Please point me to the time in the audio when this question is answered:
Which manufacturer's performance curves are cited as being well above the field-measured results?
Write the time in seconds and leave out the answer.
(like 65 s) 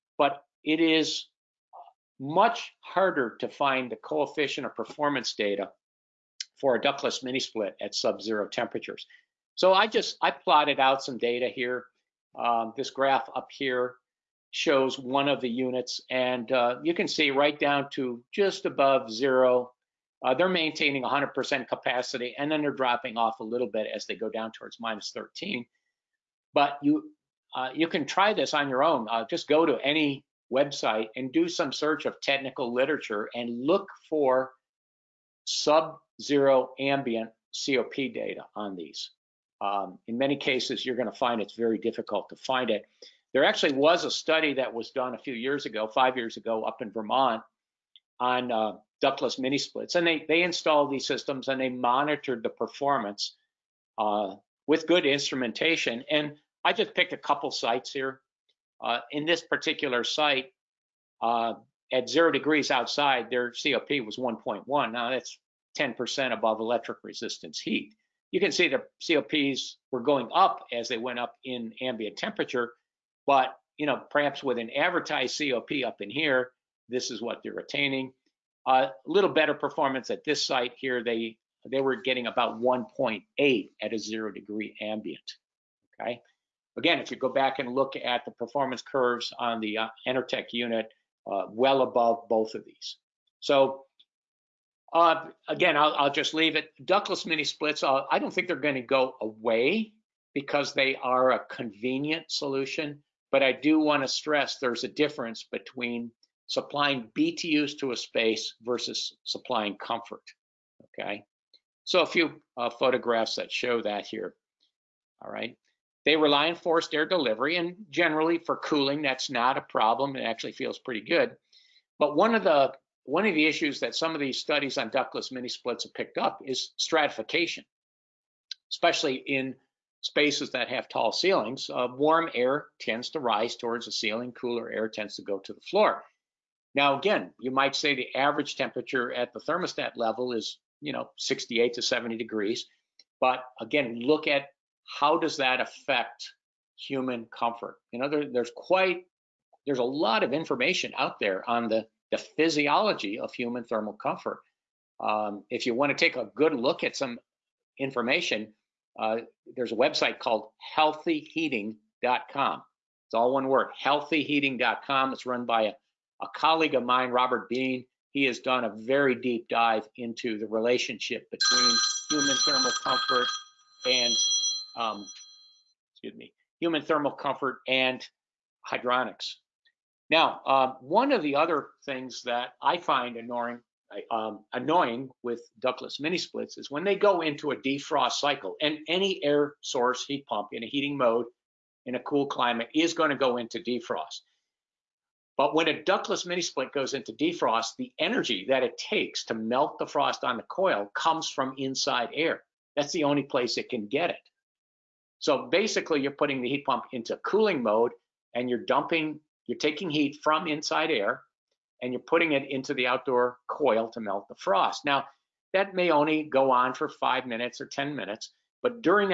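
90 s.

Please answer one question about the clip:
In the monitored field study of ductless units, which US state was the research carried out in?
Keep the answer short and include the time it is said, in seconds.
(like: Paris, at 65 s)
Vermont, at 46 s.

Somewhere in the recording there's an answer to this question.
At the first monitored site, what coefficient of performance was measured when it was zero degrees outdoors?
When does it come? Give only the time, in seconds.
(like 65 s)
64 s.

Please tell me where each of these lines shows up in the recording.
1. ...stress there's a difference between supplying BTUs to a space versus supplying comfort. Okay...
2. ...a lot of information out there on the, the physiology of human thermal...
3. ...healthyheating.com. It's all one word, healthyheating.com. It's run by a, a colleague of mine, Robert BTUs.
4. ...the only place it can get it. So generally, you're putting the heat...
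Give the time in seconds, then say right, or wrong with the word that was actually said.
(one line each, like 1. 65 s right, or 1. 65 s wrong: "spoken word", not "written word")
1. 104 s right
2. 149 s right
3. 160 s wrong: "Bean", not "BTUs"
4. 202 s wrong: "basically", not "generally".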